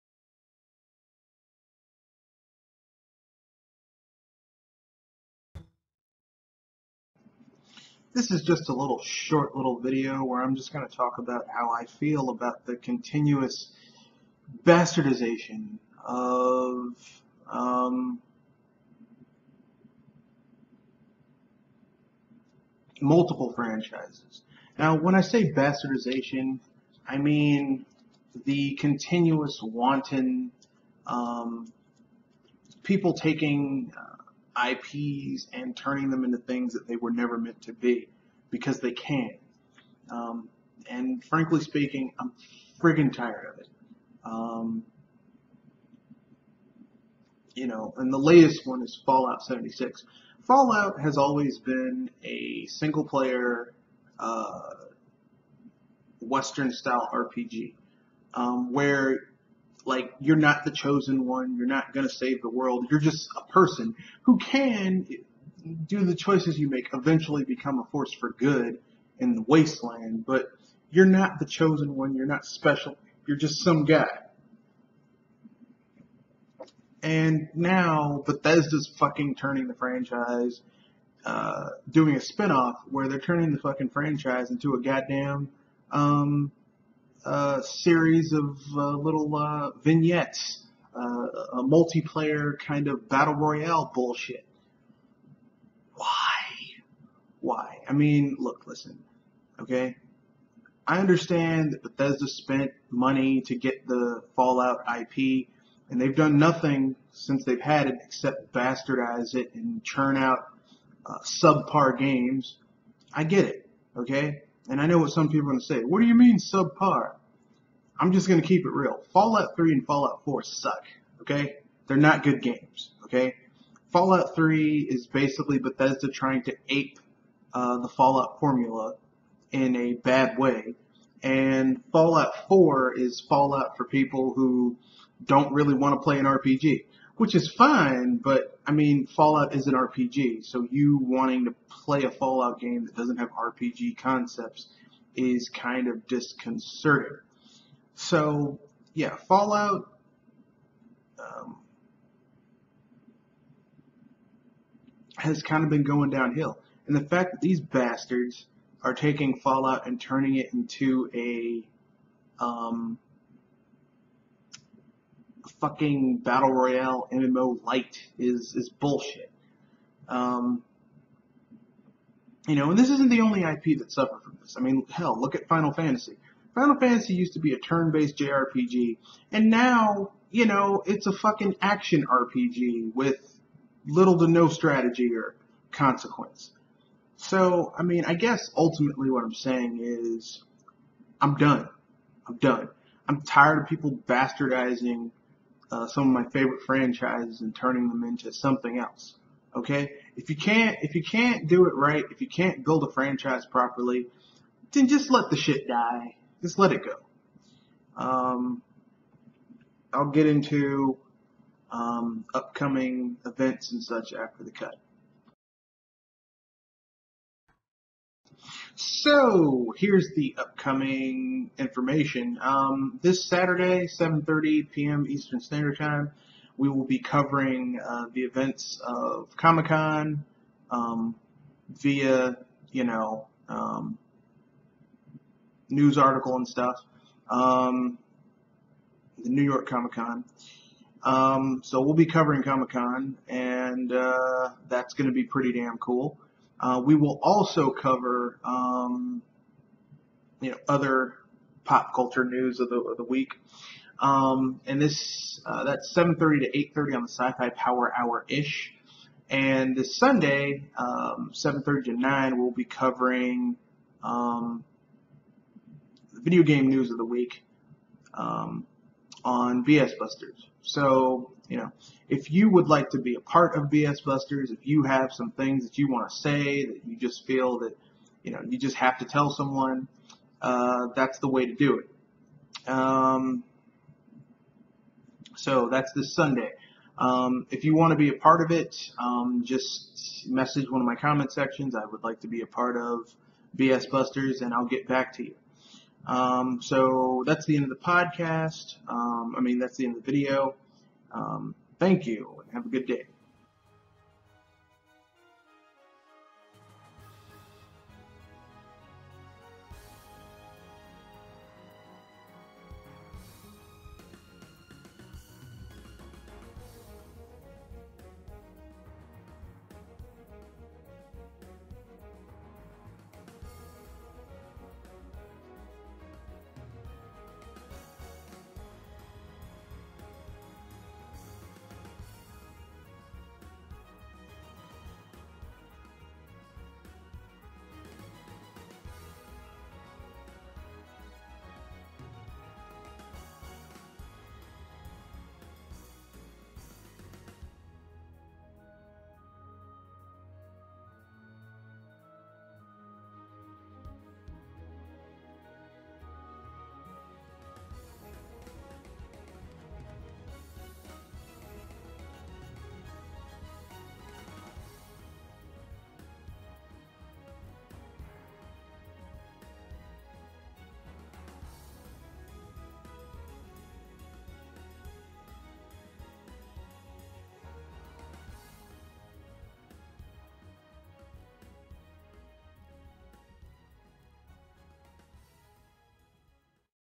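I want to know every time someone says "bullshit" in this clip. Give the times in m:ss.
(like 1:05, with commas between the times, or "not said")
1:33, 2:48.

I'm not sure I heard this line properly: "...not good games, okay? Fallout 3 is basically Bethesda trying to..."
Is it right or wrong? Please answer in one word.
right.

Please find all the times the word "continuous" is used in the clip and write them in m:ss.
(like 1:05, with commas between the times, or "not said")
0:12, 0:28.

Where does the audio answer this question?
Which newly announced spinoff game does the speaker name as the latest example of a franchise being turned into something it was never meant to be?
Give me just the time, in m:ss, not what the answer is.
0:49.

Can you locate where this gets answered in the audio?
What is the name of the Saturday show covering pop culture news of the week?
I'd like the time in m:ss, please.
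4:17.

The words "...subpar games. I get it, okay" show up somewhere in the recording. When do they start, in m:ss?
1:51.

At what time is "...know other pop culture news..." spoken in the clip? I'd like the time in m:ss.
4:10.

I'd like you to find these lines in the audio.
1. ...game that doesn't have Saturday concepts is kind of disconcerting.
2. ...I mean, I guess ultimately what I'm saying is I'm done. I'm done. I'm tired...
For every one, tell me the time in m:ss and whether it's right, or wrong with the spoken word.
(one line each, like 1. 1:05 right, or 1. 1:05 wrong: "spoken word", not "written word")
1. 2:22 wrong: "RPG", not "Saturday"
2. 3:07 right.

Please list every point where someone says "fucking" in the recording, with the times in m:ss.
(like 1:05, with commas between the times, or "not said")
1:18, 1:23, 2:45, 3:01.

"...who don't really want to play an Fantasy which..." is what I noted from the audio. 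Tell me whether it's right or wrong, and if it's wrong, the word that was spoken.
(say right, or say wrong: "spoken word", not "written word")
wrong: "RPG", not "Fantasy".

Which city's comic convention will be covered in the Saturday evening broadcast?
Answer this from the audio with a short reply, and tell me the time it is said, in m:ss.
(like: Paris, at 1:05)
New York, at 3:59.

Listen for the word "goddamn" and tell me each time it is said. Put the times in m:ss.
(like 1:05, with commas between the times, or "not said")
1:24.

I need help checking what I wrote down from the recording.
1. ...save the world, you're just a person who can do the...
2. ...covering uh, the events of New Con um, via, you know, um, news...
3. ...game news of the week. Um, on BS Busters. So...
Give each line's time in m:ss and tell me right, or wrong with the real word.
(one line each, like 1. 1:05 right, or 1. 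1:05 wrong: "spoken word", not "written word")
1. 1:02 right
2. 3:46 wrong: "Comic", not "New"
3. 4:26 right.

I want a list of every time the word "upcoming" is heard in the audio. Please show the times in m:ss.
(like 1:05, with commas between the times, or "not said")
3:32, 3:40.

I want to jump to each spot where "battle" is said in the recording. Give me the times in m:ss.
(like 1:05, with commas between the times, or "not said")
1:33, 2:46.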